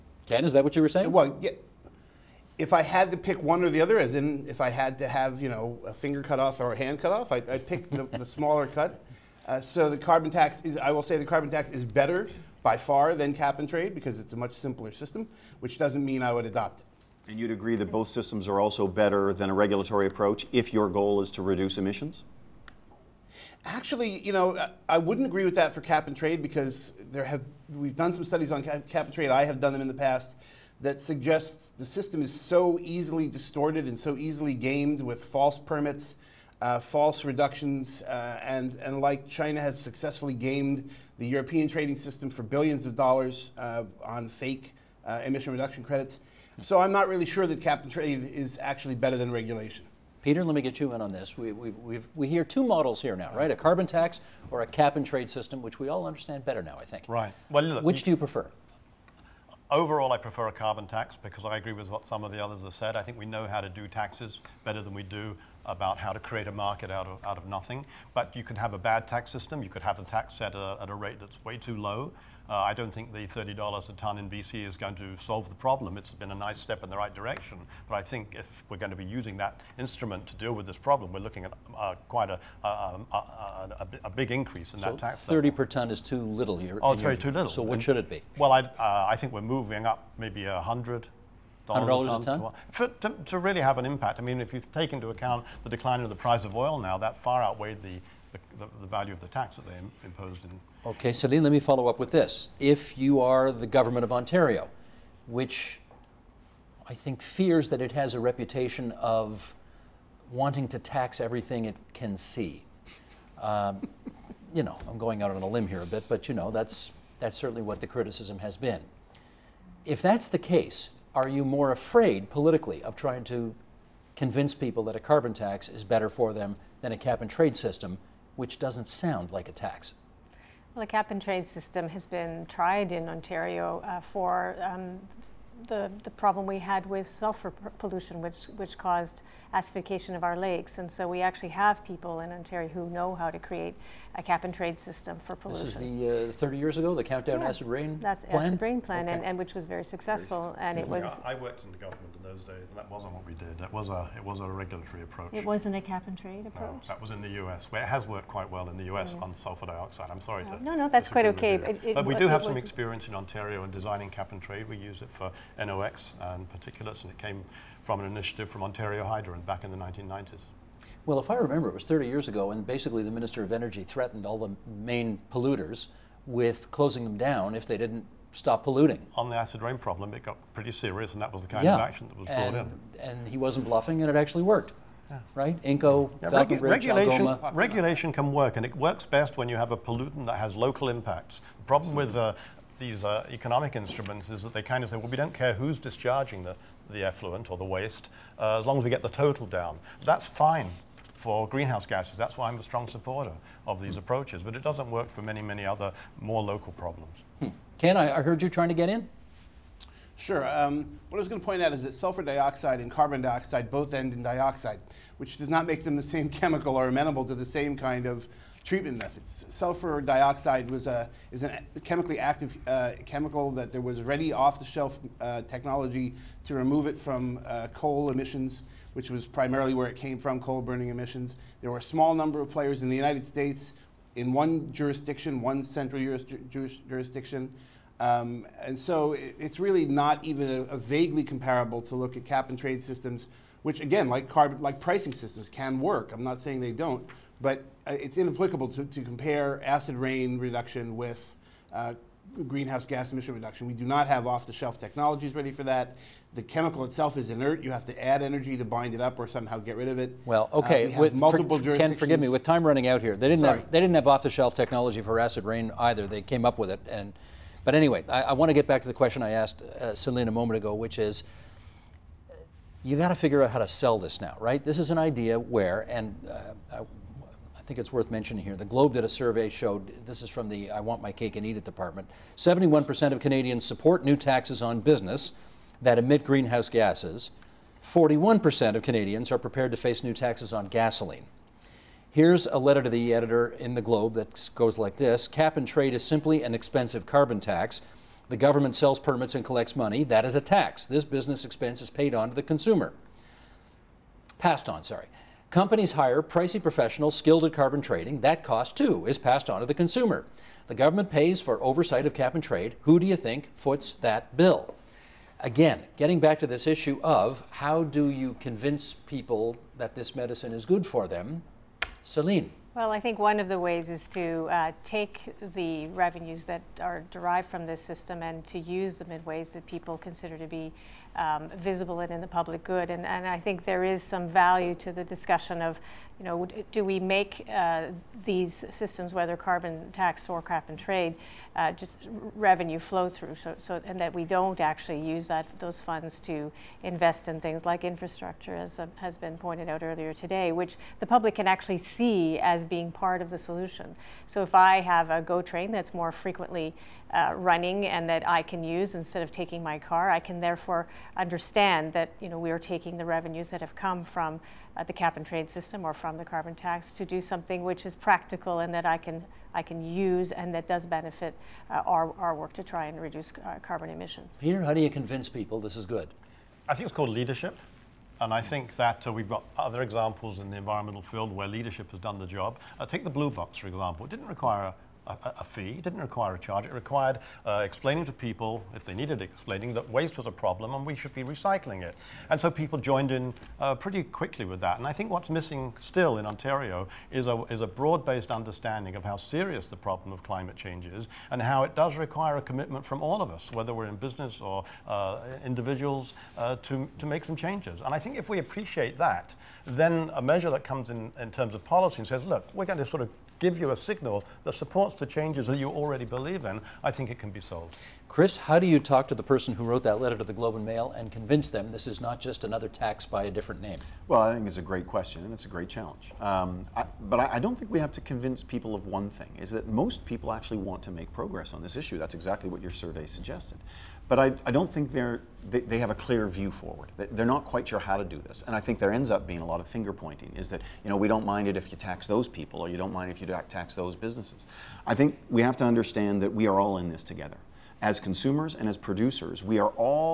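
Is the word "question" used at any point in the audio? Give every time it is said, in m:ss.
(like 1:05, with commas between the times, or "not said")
4:28, 7:04.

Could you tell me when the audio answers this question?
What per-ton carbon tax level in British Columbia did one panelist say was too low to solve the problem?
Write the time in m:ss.
1:13.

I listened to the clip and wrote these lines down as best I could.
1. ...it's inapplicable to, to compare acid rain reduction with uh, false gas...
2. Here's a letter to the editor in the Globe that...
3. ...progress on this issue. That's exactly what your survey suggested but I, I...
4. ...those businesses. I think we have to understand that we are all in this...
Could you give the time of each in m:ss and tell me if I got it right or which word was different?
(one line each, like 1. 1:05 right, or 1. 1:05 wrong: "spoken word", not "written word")
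1. 4:07 wrong: "greenhouse", not "false"
2. 4:52 right
3. 7:11 right
4. 7:23 right.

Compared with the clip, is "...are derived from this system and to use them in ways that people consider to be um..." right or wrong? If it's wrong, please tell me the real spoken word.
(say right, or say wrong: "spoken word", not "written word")
right.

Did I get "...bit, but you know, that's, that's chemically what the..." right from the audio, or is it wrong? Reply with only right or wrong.
wrong.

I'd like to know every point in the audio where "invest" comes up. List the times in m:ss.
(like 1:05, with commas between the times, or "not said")
5:46.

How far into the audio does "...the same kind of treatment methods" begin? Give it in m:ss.
3:37.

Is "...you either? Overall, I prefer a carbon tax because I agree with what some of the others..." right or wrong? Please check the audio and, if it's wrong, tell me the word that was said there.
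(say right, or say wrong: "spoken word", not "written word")
wrong: "prefer", not "either".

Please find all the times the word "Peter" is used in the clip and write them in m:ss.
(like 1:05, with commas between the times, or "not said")
0:50, 6:14.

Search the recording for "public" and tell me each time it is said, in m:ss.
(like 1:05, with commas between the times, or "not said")
5:32, 5:51.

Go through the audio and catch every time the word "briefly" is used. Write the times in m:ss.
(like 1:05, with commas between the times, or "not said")
not said.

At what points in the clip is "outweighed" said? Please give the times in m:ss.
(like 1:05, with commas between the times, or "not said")
1:37.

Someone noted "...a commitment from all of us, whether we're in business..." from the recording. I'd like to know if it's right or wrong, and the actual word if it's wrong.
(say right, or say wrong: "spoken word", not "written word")
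right.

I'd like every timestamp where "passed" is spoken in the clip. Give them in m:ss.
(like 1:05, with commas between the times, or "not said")
5:04, 5:09.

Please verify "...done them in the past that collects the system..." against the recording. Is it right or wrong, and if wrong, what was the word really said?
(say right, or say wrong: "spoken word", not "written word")
wrong: "suggests", not "collects".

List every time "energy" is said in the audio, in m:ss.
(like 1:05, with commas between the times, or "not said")
2:53, 4:18.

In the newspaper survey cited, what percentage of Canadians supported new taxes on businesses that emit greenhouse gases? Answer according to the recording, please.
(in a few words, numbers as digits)
71%.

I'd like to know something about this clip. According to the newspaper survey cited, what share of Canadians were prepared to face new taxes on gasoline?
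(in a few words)
41%.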